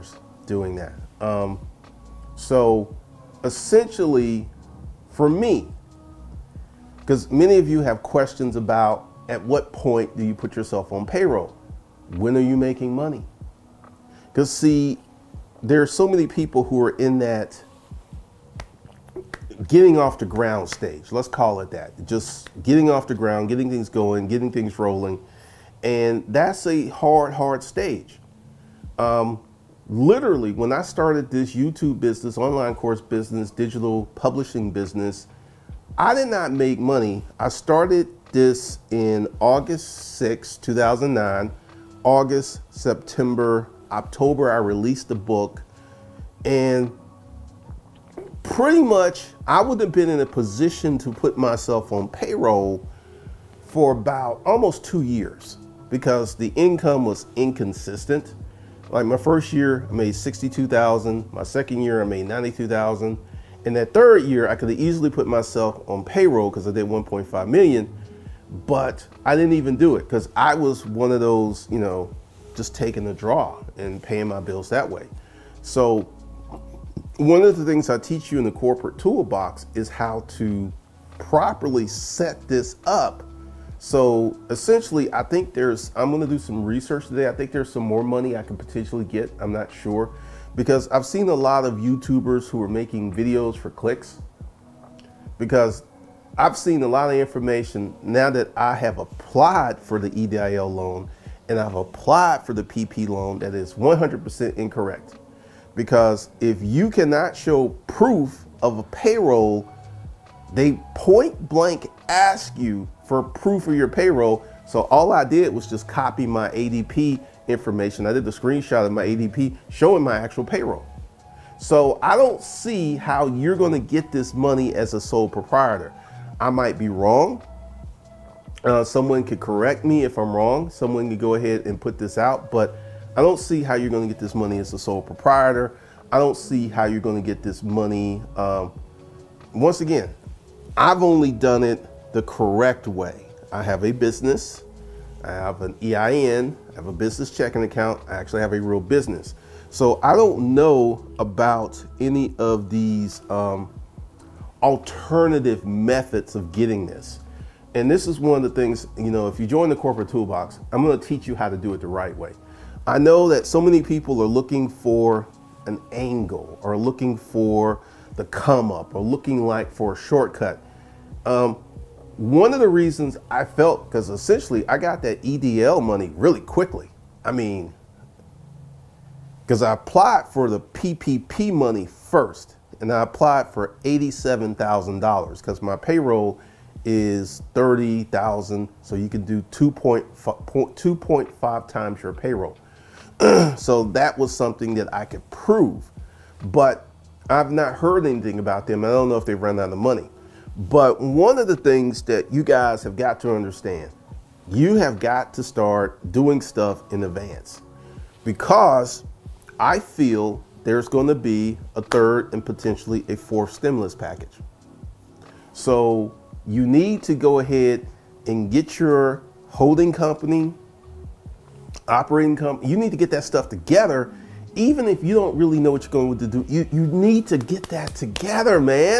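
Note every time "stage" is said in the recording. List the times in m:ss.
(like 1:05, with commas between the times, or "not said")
0:20, 0:27.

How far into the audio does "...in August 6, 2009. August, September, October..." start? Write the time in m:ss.
0:38.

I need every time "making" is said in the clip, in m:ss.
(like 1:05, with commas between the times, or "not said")
0:12, 1:32.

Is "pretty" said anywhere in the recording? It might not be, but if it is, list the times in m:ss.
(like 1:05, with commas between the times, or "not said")
0:48.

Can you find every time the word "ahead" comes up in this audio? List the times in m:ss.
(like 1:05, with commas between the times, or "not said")
2:11, 3:37.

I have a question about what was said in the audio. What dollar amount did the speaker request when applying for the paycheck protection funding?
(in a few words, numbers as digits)
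$87,000.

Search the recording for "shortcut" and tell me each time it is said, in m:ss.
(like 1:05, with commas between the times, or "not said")
2:49.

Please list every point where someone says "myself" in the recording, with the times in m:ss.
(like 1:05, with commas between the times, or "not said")
0:51, 1:05.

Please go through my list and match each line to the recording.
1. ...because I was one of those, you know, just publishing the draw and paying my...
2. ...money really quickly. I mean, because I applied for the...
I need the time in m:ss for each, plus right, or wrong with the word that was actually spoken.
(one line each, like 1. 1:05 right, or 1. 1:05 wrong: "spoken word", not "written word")
1. 1:10 wrong: "taking", not "publishing"
2. 2:55 right.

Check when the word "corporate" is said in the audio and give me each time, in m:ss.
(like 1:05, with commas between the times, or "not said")
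1:18, 2:39.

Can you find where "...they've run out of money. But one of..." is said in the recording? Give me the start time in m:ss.
3:19.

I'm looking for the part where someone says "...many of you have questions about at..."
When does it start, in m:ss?
0:07.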